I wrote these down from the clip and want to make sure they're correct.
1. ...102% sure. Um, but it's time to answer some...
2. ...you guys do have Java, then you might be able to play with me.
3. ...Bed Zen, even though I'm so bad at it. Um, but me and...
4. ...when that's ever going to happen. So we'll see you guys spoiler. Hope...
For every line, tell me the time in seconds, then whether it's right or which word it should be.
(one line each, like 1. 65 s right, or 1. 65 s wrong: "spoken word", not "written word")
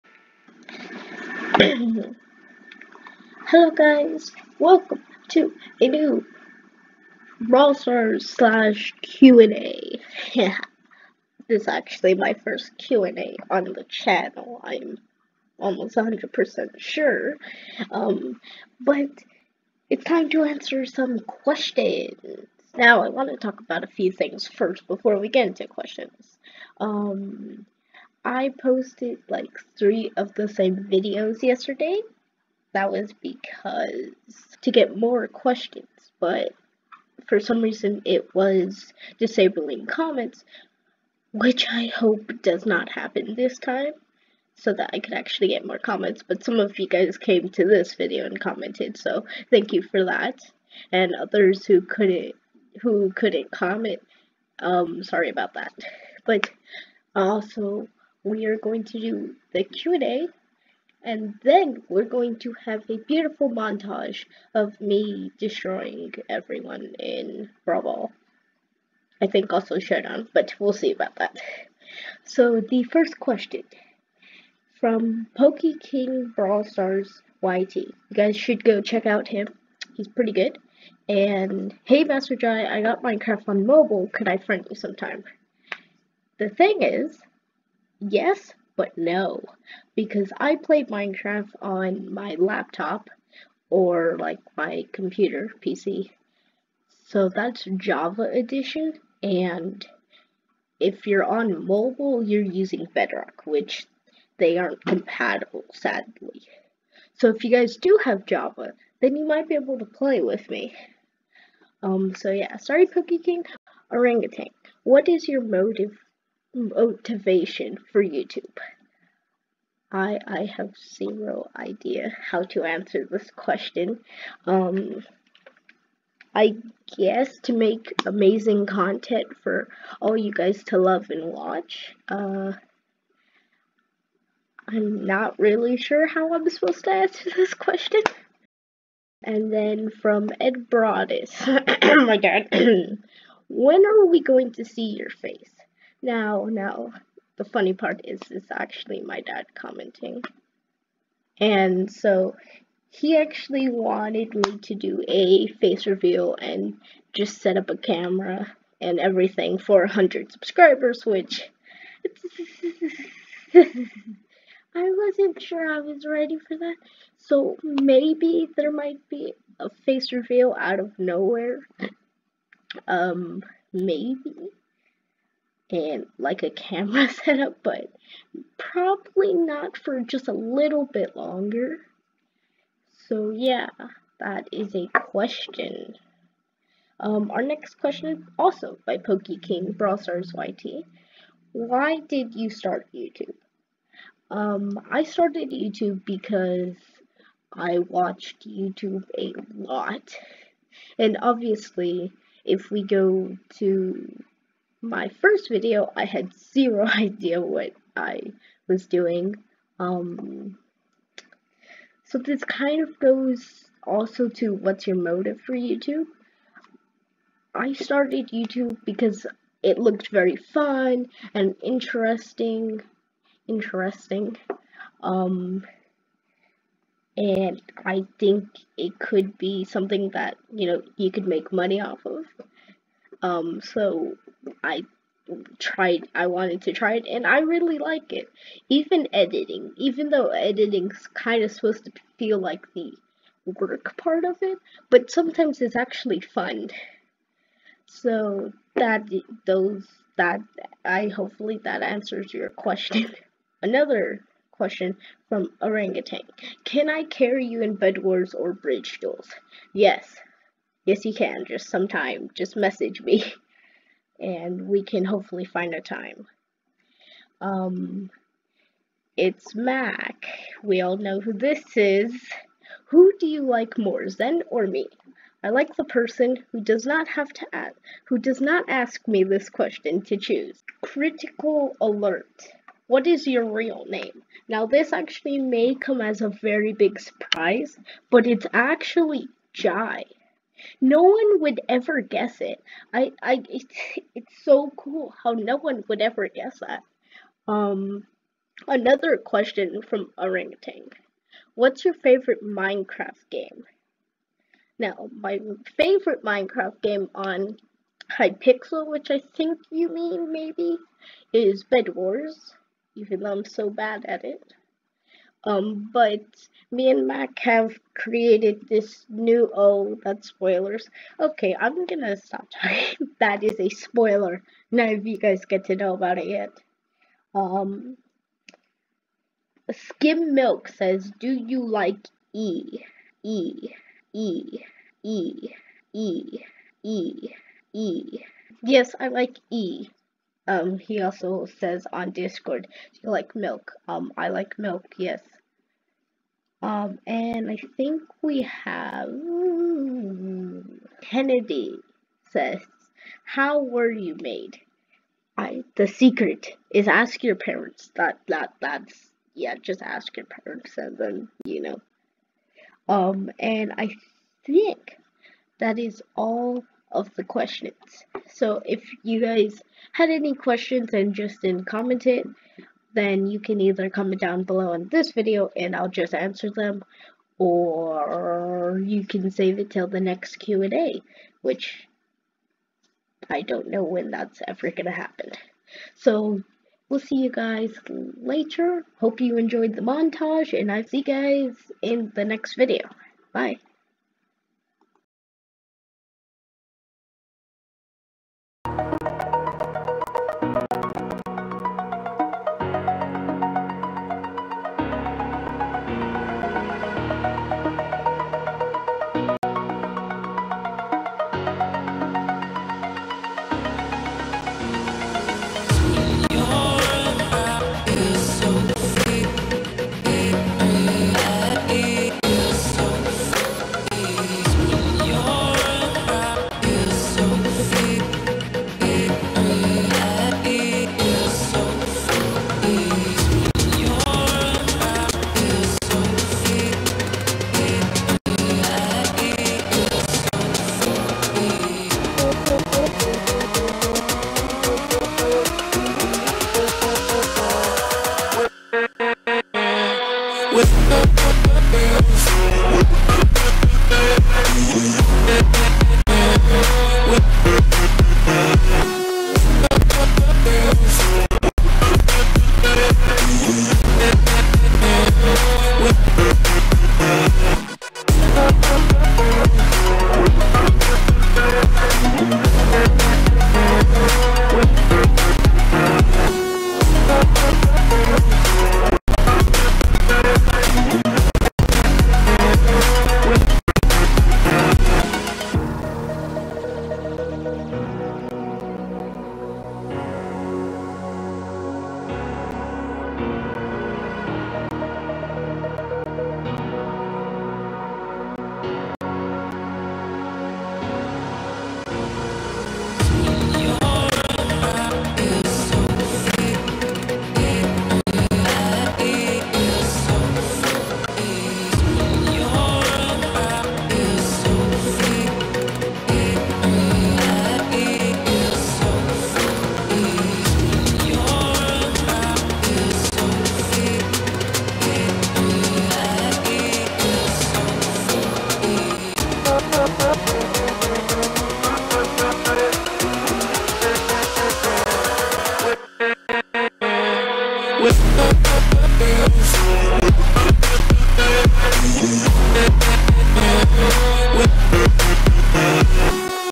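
1. 15 s wrong: "100", not "102"
2. 107 s right
3. 311 s wrong: "Wars", not "Zen"
4. 383 s wrong: "later", not "spoiler".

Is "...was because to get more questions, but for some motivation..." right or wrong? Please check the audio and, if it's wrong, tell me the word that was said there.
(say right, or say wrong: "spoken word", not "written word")
wrong: "reason", not "motivation".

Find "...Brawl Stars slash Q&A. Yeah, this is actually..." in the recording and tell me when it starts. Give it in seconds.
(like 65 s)
7 s.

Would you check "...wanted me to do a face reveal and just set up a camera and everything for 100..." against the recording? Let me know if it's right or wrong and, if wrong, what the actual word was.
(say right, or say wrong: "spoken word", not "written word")
right.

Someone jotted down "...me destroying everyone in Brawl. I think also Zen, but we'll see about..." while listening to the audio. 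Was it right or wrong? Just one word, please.
wrong.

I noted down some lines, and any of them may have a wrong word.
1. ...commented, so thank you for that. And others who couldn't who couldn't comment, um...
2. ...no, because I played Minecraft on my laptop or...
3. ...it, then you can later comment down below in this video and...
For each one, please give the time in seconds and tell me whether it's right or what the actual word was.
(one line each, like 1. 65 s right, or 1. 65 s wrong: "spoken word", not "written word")
1. 48 s right
2. 88 s right
3. 372 s wrong: "either", not "later".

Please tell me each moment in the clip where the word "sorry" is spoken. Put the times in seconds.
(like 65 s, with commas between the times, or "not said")
55 s, 112 s.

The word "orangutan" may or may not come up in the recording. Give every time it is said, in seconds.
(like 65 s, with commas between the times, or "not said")
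113 s, 255 s, 300 s.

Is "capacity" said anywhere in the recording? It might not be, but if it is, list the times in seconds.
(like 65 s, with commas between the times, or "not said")
not said.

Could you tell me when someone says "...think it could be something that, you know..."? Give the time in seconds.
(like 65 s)
228 s.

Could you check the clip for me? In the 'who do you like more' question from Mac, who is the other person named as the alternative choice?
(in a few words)
Zen.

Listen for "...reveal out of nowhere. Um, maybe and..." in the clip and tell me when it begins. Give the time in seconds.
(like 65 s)
170 s.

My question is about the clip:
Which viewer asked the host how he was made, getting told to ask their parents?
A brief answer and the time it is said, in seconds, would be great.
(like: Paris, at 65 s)
Kennedy, at 351 s.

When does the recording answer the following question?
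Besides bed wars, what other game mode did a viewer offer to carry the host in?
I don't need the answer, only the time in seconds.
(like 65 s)
258 s.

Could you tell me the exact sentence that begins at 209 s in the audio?
Um, so this kind of goes also to what's your motive for YouTube.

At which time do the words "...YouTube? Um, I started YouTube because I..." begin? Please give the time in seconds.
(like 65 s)
192 s.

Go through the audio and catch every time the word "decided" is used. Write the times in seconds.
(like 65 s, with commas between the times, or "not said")
not said.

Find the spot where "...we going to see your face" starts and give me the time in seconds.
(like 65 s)
144 s.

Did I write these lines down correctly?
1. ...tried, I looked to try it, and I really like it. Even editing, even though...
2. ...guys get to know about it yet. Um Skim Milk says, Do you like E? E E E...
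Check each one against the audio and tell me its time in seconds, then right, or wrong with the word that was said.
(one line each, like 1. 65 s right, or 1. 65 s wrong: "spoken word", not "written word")
1. 235 s wrong: "wanted", not "looked"
2. 325 s right.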